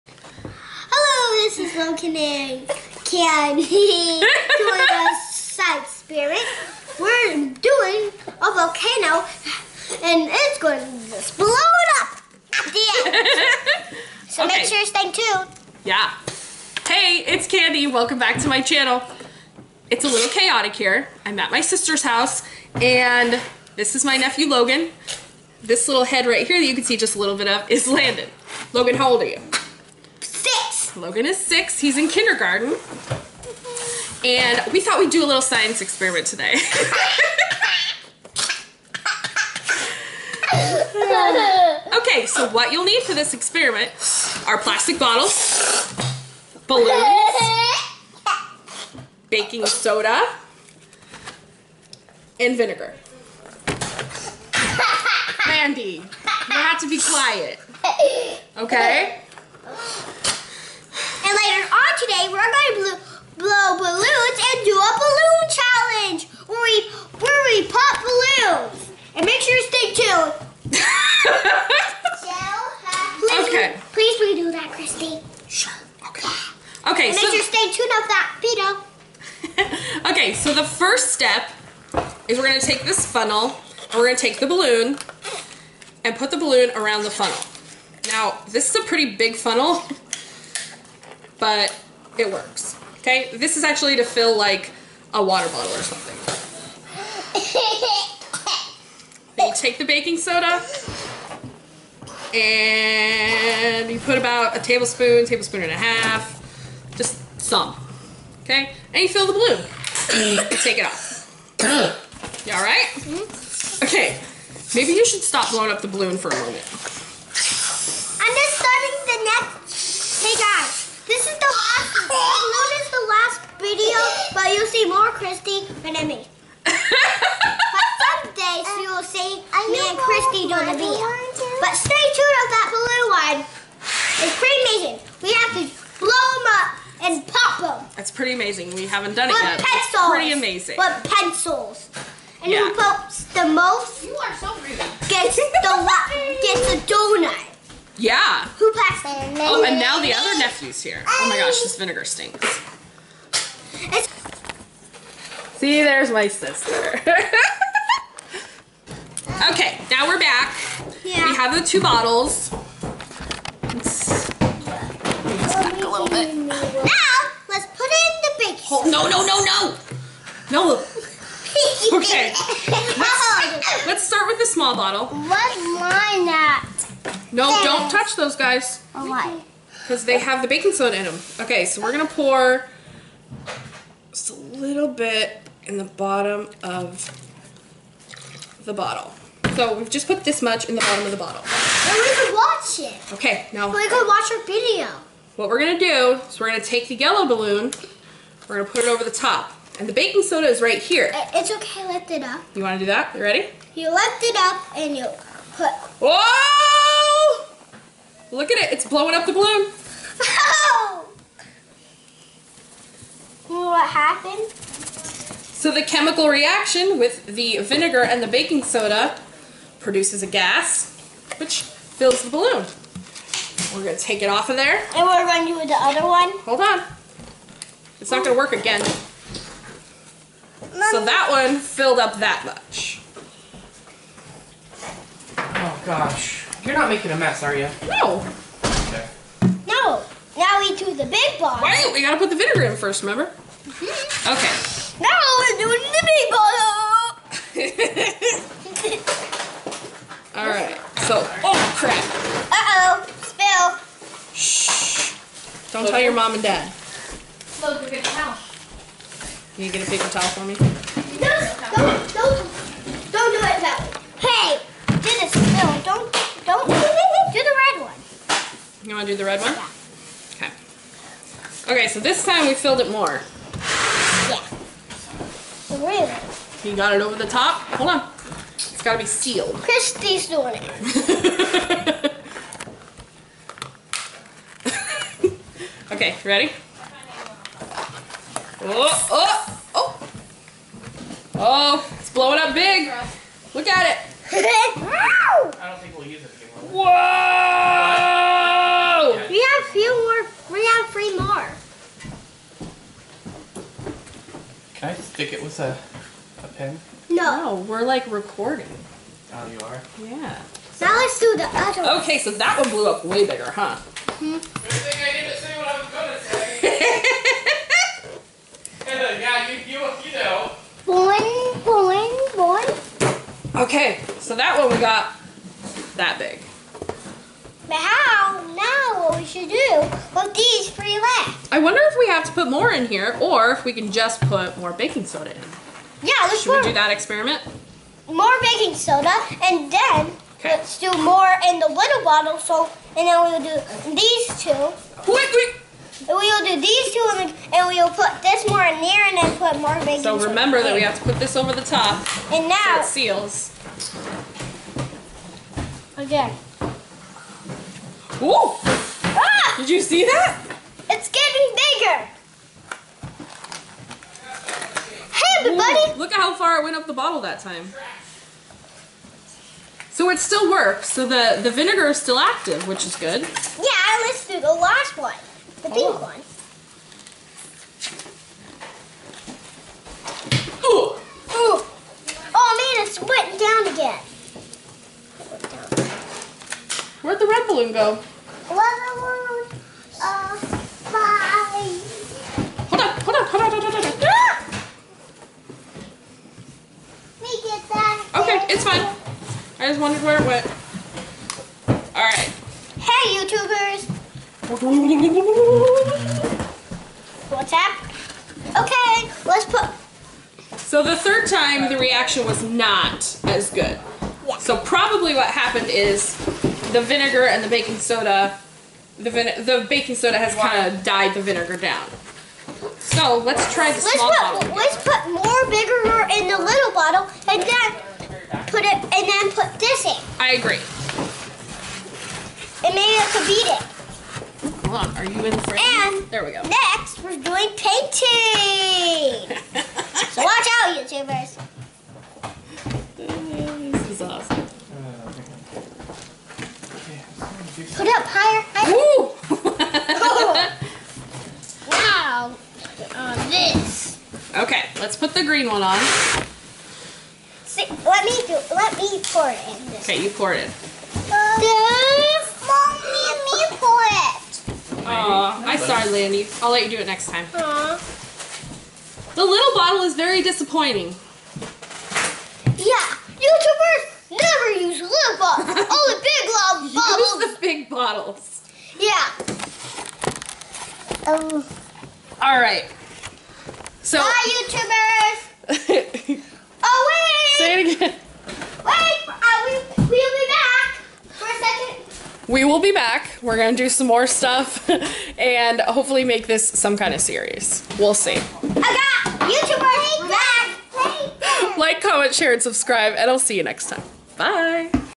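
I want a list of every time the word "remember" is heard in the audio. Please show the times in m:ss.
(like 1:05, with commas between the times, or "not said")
4:03, 5:50.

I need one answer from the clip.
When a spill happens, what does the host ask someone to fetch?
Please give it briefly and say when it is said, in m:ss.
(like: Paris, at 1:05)
A paper towel, at 4:19.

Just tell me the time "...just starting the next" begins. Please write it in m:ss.
1:58.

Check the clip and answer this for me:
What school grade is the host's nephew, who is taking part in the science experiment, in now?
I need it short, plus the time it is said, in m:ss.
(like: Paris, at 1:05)
Kindergarten, at 0:32.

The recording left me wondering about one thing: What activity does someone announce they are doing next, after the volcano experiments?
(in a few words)
Painting.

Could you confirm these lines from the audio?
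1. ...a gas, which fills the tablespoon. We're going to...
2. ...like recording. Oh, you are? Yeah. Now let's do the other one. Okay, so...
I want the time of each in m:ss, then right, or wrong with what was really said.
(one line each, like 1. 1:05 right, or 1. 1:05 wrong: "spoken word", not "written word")
1. 3:40 wrong: "balloon", not "tablespoon"
2. 5:07 right.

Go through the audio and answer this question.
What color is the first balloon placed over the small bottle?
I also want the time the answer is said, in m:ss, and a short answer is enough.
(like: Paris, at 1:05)
Yellow, at 3:16.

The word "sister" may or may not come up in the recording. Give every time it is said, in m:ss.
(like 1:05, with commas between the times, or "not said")
0:21, 2:36.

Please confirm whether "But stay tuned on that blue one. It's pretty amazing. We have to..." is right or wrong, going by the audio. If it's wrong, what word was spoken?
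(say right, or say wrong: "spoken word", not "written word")
right.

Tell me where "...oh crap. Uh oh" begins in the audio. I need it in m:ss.
4:11.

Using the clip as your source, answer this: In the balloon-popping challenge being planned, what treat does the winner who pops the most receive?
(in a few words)
Donut.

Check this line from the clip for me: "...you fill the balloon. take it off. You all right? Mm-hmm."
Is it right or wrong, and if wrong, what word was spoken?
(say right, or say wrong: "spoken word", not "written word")
right.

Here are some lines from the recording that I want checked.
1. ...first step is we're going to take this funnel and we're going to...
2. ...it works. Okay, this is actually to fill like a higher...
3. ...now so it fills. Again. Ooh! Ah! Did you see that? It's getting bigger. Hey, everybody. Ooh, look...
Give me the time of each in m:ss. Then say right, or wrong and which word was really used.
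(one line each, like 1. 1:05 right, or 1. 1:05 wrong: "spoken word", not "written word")
1. 1:20 right
2. 1:32 wrong: "water", not "higher"
3. 5:52 wrong: "seals", not "fills".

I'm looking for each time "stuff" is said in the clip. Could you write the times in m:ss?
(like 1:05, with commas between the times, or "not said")
8:14.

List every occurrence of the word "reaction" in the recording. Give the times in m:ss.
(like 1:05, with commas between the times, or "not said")
3:36, 6:51.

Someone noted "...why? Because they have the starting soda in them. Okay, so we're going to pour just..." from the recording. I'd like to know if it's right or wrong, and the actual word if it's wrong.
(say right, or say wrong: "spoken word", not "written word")
wrong: "baking", not "starting".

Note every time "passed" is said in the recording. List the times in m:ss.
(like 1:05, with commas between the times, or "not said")
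2:28.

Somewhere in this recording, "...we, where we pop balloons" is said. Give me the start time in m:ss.
1:06.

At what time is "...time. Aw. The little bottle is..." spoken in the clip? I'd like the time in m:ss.
7:47.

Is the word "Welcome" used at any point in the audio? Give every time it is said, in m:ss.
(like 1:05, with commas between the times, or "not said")
0:17.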